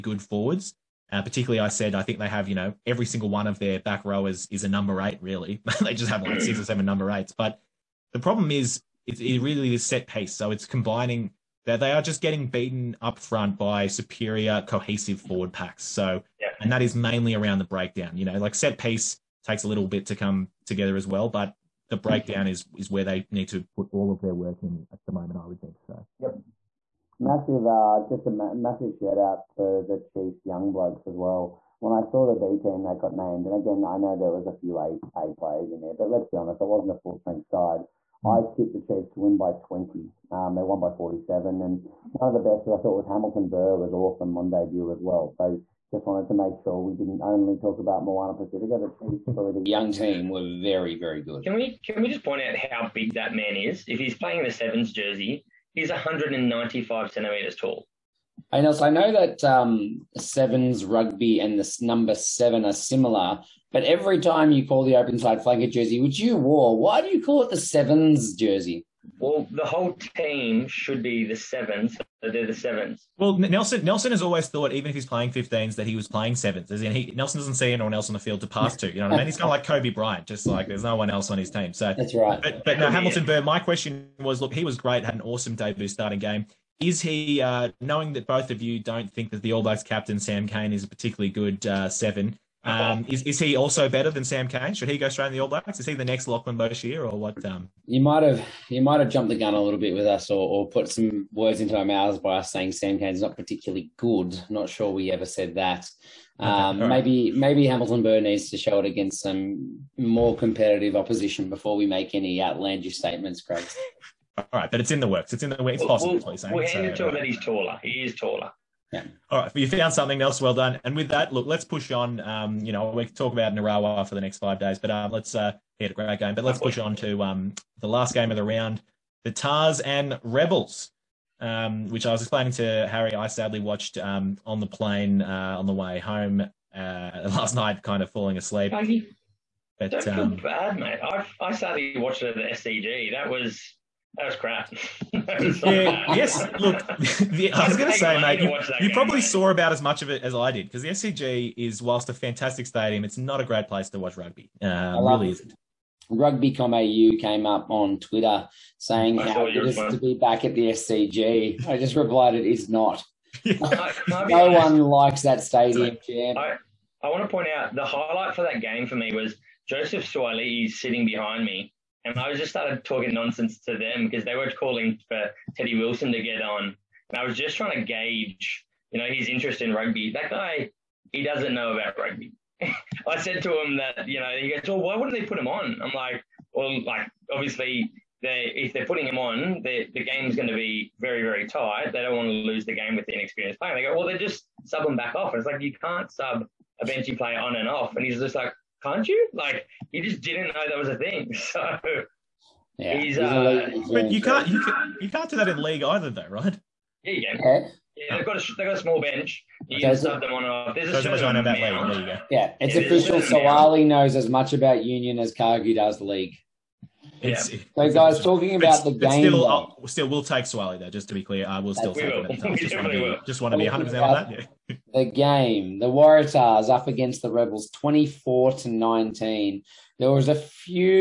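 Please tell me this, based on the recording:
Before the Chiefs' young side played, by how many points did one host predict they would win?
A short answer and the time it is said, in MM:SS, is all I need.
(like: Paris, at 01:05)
20, at 00:39.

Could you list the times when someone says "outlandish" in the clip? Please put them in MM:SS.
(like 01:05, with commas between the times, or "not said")
01:52.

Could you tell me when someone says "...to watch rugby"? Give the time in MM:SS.
02:33.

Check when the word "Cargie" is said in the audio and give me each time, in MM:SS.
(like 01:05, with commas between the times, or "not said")
03:35.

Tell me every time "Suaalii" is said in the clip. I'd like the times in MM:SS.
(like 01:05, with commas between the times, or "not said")
02:50, 03:33.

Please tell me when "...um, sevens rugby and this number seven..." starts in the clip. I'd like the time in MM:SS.
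00:59.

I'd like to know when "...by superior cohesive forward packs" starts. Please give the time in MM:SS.
00:13.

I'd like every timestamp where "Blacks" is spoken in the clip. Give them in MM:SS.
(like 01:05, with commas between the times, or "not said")
01:29, 01:35.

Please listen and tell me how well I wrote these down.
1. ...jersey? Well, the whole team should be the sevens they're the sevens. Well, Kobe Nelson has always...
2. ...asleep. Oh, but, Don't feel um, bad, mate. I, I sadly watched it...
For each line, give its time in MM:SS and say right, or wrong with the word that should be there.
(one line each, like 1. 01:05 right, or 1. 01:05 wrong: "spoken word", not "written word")
1. 01:08 wrong: "Nelson", not "Kobe"
2. 02:18 right.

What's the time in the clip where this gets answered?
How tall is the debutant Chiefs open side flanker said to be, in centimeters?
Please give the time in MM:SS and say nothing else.
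00:55.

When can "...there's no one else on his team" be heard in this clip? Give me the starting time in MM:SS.
01:20.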